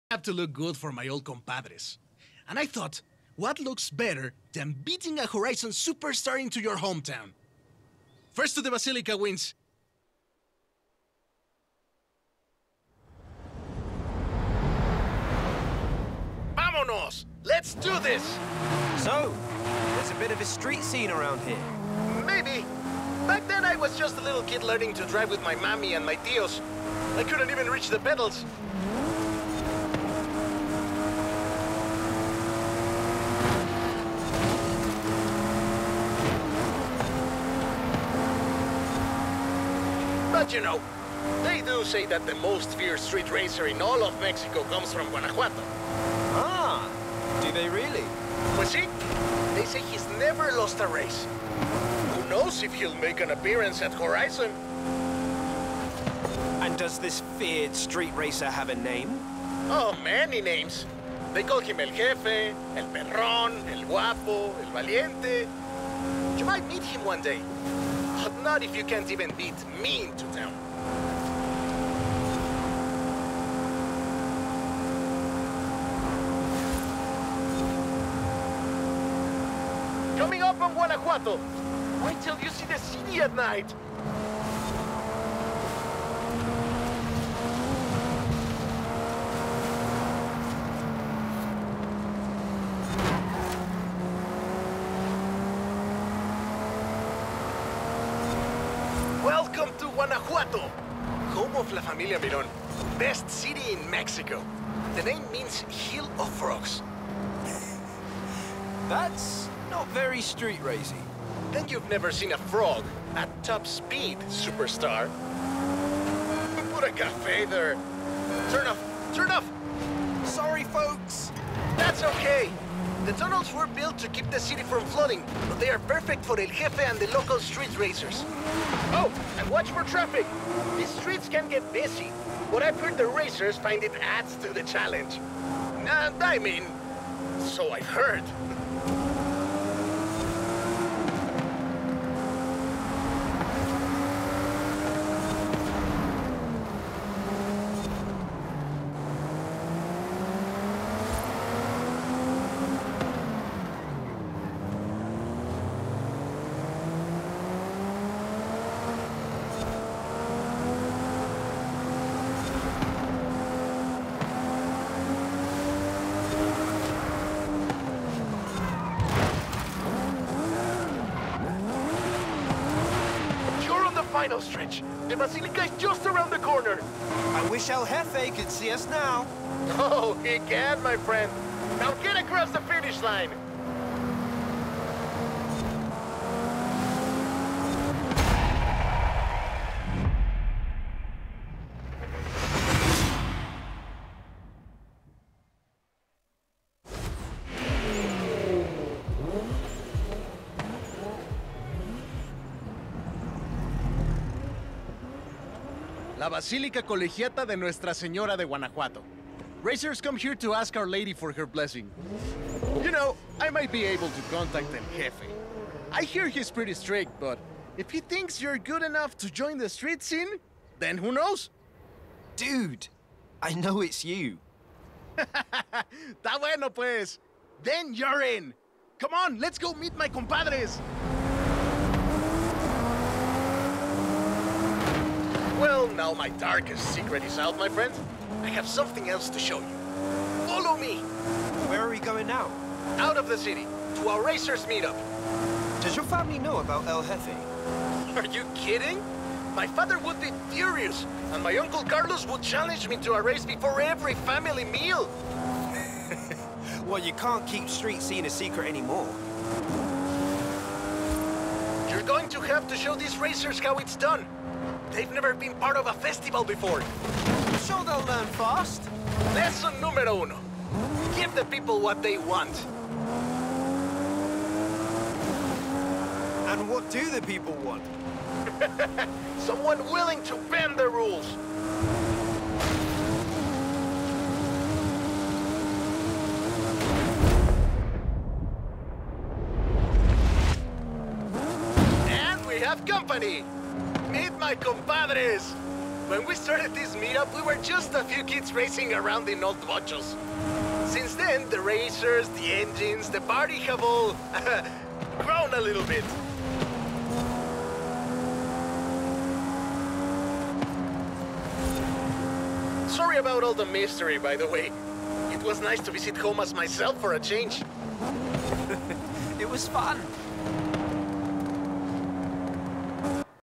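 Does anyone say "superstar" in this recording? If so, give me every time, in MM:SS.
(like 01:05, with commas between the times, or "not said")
00:05, 01:54.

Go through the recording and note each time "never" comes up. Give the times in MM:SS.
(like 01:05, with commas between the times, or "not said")
00:50, 01:51, 04:25.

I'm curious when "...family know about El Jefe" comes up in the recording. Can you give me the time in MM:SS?
04:06.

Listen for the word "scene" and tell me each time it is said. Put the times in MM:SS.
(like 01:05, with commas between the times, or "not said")
00:20, 03:40, 04:18.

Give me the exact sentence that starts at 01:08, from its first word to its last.
Not if you can't even beat me into town.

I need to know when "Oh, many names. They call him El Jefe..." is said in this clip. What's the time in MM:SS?
00:59.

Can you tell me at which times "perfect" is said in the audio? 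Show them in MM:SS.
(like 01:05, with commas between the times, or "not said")
02:05.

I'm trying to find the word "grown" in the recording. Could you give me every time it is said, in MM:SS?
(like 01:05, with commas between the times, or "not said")
05:05.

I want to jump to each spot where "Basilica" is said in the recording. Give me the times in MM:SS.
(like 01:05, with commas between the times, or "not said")
00:08, 02:55.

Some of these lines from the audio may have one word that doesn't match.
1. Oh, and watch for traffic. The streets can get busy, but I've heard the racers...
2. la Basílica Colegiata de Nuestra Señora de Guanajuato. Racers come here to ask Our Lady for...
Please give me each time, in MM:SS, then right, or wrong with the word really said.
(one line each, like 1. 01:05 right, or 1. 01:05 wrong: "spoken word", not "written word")
1. 02:08 right
2. 03:26 right.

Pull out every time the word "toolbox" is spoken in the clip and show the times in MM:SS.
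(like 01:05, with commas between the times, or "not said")
not said.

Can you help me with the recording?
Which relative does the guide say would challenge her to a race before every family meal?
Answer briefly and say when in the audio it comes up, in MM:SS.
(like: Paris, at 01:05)
Uncle Carlos, at 04:11.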